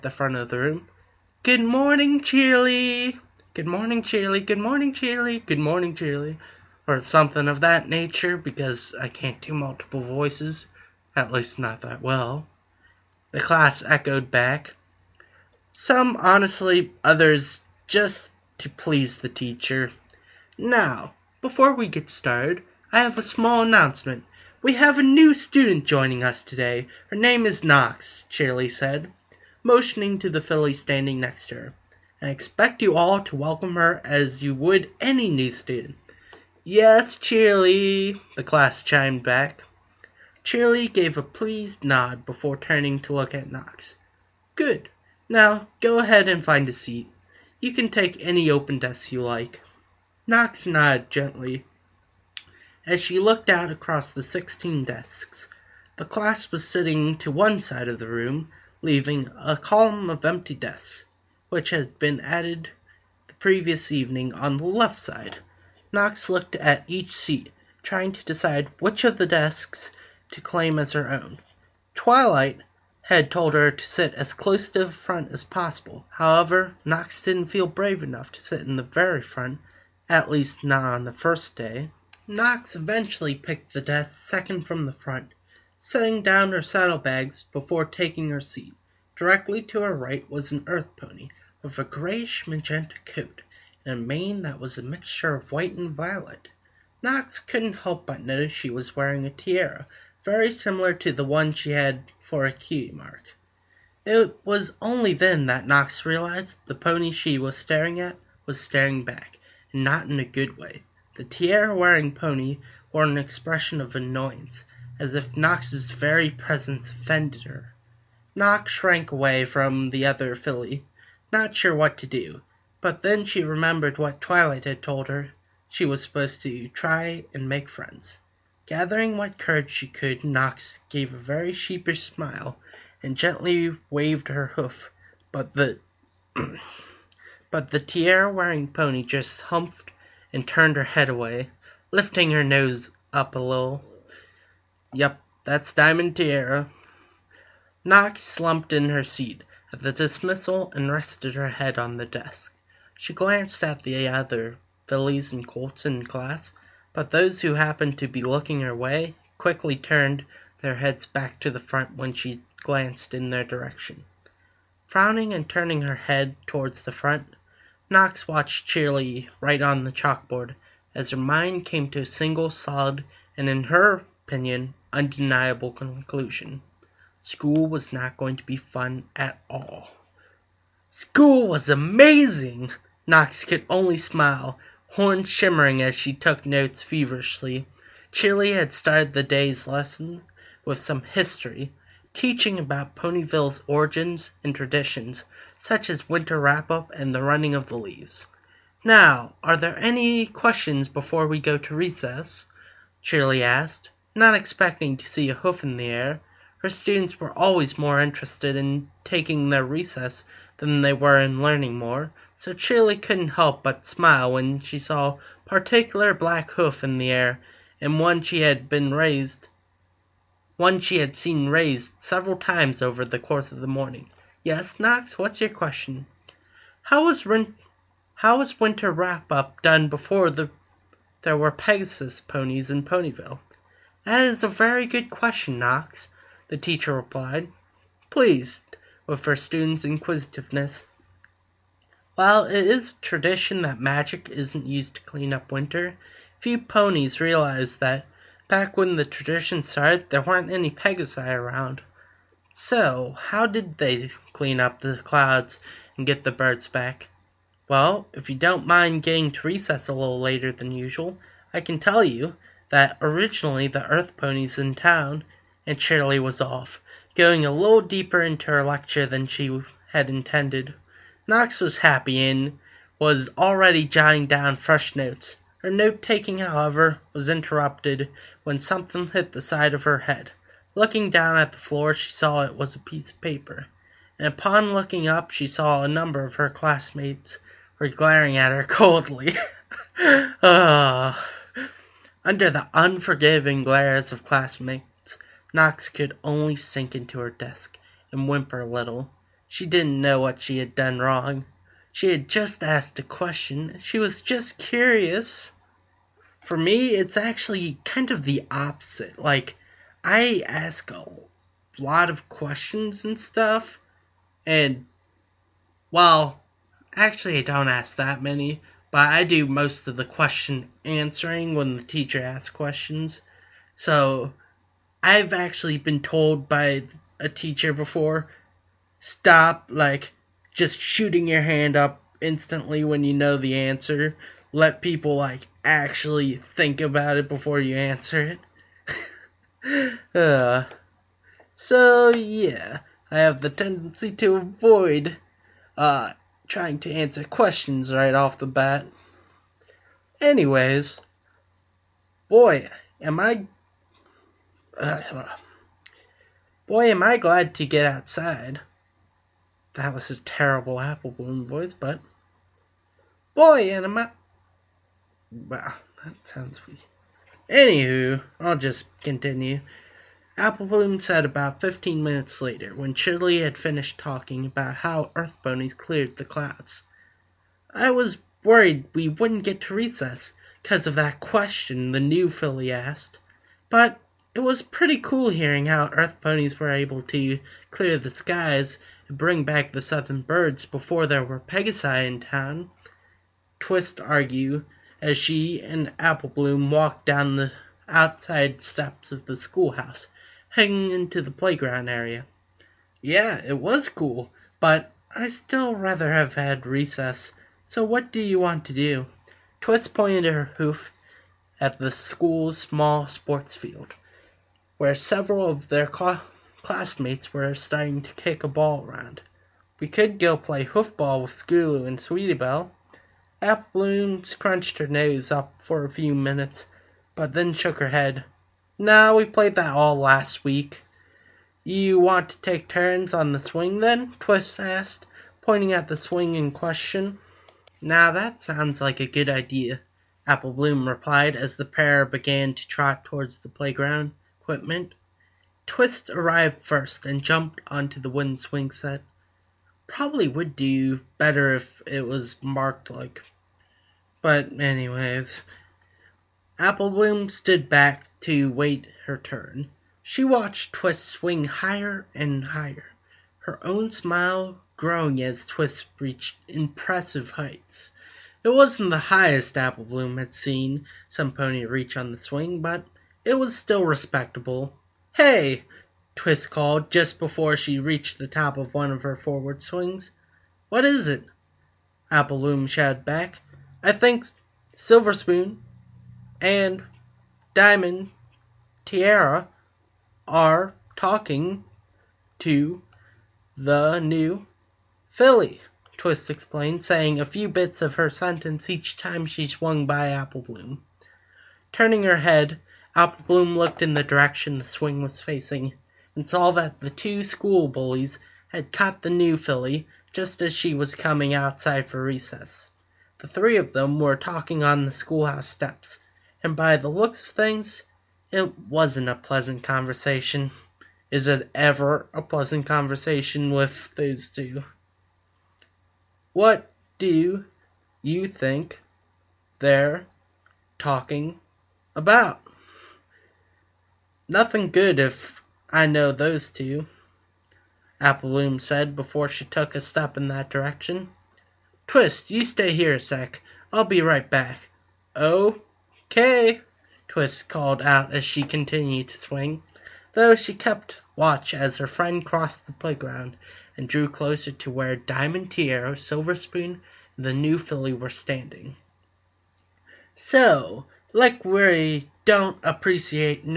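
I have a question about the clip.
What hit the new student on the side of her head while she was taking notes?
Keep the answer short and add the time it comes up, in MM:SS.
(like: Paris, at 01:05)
A piece of paper, at 04:42.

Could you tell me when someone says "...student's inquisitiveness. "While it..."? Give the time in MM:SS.
03:59.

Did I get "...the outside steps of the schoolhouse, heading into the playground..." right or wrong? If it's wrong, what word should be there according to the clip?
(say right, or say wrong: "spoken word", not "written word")
right.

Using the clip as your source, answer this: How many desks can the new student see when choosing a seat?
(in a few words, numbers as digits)
16.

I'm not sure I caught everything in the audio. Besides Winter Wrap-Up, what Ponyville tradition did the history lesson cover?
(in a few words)
Running of the Leaves.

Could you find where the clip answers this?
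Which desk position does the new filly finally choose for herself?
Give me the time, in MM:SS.
01:24.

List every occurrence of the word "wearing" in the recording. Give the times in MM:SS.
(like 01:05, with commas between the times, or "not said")
01:38, 01:51, 02:17.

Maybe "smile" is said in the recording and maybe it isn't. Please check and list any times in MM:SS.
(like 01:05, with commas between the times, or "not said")
02:12, 03:03, 03:33, 07:43.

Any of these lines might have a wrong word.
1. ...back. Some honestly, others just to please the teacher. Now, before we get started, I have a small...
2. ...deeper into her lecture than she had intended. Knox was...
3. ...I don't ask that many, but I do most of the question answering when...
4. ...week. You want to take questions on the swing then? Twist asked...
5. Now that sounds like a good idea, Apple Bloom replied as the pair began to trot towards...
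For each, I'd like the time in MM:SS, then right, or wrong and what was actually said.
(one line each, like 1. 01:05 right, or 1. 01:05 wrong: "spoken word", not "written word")
1. 00:14 right
2. 04:27 right
3. 05:17 right
4. 07:10 wrong: "turns", not "questions"
5. 07:17 right.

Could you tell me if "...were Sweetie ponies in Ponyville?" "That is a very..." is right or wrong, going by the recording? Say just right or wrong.
wrong.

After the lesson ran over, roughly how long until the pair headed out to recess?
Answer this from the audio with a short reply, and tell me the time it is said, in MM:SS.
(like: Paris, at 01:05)
15 minutes, at 06:11.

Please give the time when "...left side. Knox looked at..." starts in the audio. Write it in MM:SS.
01:04.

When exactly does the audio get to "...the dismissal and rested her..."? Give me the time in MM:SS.
02:29.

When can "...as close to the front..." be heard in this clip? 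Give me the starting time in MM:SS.
01:14.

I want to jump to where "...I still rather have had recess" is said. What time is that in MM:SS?
06:45.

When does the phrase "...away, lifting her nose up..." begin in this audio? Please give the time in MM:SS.
02:21.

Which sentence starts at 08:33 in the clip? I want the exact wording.
The three of them were talking on the schoolhouse steps, and by the looks of things it wasn't a pleasant conversation.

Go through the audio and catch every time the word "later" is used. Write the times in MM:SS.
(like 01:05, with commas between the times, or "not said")
04:20, 06:12.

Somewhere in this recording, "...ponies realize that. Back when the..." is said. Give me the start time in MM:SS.
04:06.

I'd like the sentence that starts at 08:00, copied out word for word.
"What is it?" Bloom shouted back.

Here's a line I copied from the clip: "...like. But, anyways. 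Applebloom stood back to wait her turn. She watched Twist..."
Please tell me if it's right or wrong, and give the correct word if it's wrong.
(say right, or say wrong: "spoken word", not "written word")
right.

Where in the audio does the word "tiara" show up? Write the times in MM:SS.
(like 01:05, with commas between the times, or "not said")
01:39, 01:51, 02:17, 02:26, 08:08, 09:15.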